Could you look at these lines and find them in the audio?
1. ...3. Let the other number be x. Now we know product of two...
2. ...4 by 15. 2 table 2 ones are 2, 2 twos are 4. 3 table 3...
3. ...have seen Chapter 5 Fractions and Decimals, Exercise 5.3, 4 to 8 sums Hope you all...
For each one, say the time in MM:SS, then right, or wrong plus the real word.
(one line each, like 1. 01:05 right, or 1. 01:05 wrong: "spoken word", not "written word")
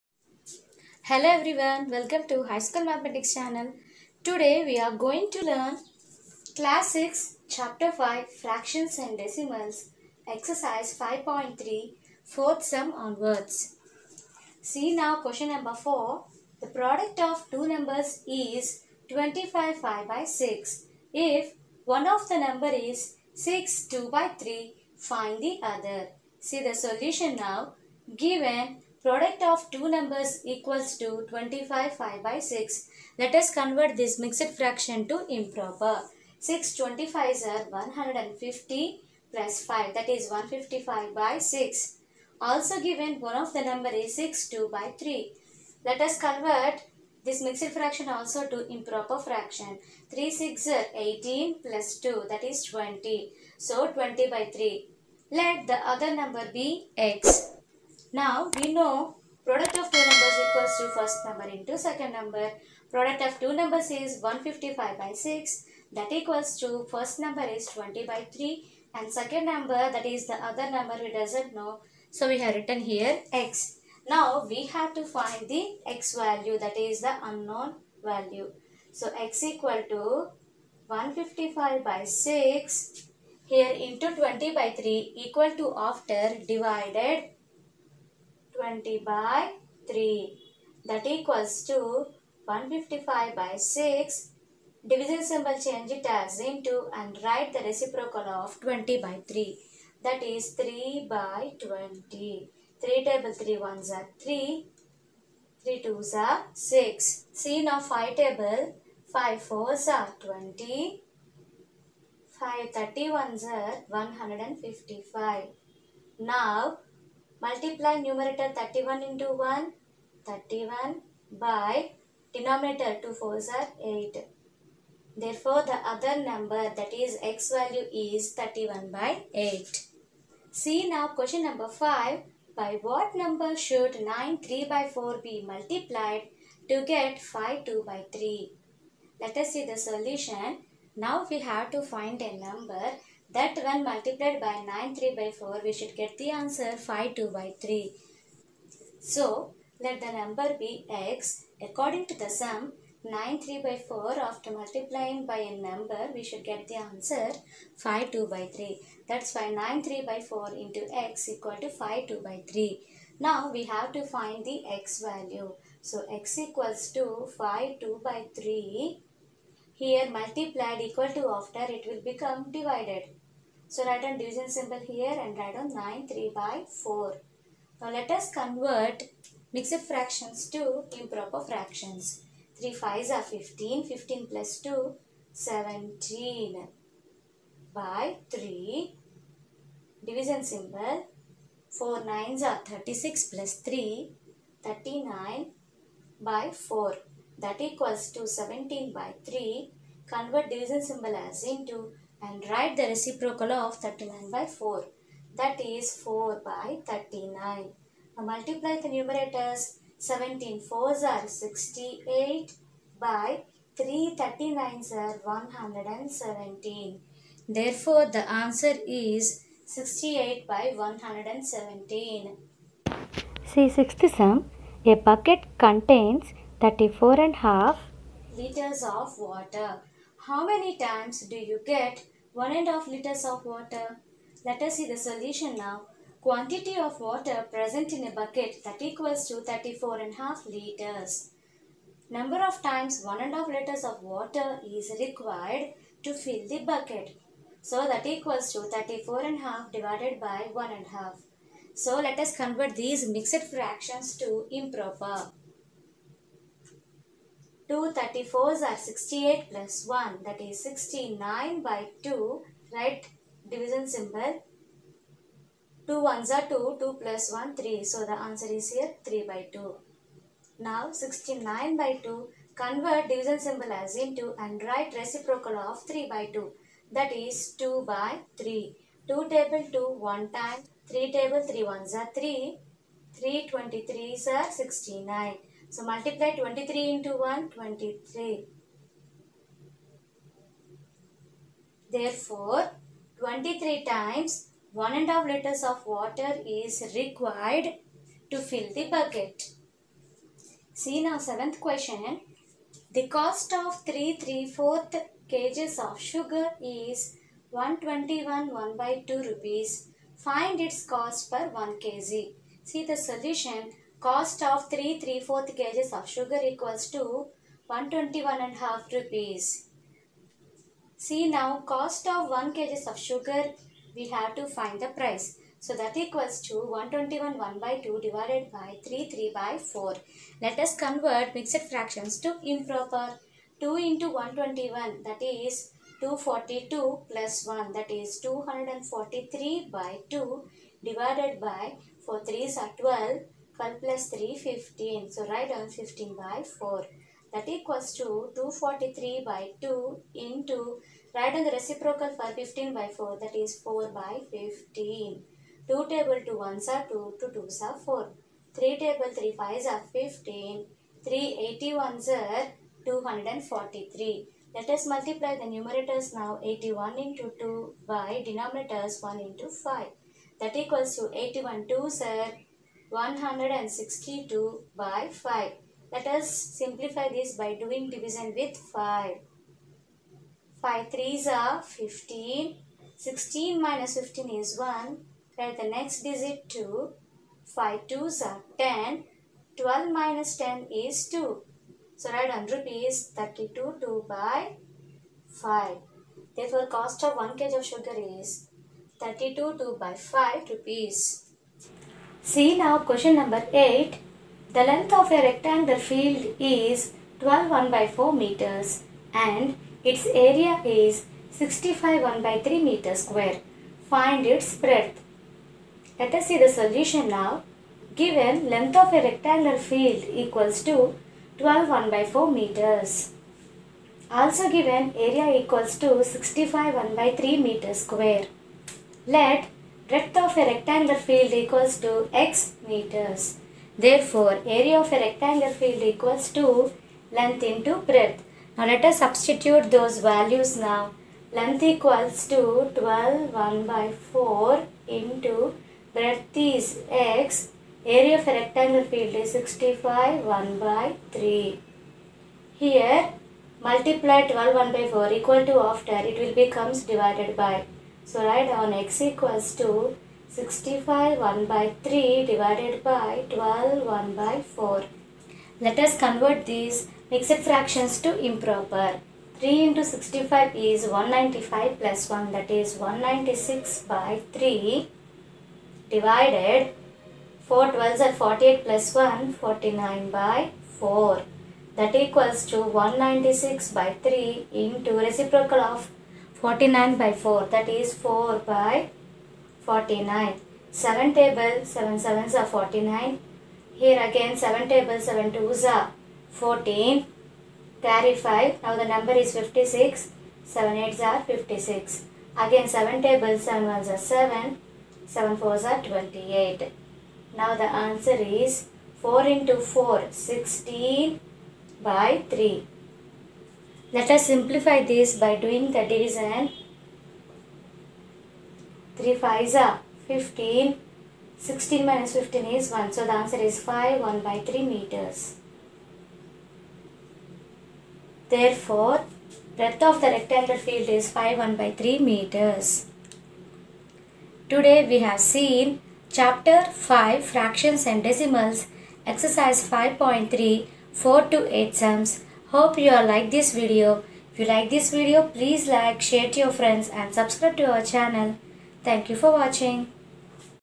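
1. 00:54 right
2. 05:53 right
3. 08:54 right.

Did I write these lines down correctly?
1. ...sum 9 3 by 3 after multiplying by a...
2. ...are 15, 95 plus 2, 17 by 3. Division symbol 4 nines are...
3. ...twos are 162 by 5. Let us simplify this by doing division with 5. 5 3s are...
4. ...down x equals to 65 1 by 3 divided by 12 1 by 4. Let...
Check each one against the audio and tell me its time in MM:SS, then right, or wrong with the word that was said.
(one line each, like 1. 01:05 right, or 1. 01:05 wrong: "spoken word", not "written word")
1. 02:32 wrong: "4", not "3"
2. 03:03 wrong: "15", not "95"
3. 06:11 right
4. 07:38 right.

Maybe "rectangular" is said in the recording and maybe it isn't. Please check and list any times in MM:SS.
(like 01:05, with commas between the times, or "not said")
06:45, 06:59, 07:10, 07:15, 07:28, 08:50.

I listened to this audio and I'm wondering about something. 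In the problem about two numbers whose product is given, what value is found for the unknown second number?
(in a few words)
31/8.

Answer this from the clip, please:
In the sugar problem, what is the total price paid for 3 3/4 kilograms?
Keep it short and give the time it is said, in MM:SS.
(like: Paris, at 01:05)
121 1/2 rupees, at 05:17.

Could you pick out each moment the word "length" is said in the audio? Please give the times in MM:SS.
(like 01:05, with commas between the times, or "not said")
06:44, 06:58, 07:17, 07:21.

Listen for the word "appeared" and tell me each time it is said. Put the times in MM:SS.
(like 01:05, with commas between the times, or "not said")
not said.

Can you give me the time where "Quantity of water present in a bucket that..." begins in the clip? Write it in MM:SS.
03:56.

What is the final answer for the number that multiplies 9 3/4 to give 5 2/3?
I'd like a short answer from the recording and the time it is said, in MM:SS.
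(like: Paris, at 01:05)
68/117, at 03:39.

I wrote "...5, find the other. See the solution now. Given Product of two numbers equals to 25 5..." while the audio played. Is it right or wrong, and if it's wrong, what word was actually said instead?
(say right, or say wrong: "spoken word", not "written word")
wrong: "3", not "5".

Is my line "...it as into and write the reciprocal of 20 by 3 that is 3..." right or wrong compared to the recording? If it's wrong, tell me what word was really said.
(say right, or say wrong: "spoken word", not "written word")
right.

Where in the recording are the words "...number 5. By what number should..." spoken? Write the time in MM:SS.
02:11.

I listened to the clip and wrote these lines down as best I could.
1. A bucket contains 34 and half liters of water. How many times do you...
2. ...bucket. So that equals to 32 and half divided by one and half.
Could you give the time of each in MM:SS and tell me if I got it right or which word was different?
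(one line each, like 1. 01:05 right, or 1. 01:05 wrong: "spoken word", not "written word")
1. 03:44 right
2. 04:06 wrong: "34", not "32".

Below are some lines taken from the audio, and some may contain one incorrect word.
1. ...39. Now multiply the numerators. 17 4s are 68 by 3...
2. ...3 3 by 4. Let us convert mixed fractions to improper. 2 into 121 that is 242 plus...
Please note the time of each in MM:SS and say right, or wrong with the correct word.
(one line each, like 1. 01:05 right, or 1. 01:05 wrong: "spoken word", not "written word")
1. 03:26 right
2. 05:28 right.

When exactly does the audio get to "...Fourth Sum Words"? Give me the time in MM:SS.
00:12.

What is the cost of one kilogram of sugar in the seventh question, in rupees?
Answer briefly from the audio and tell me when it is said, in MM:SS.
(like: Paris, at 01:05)
32 2/5 rupees, at 06:38.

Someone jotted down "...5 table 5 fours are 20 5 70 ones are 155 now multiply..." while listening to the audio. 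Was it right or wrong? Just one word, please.
wrong.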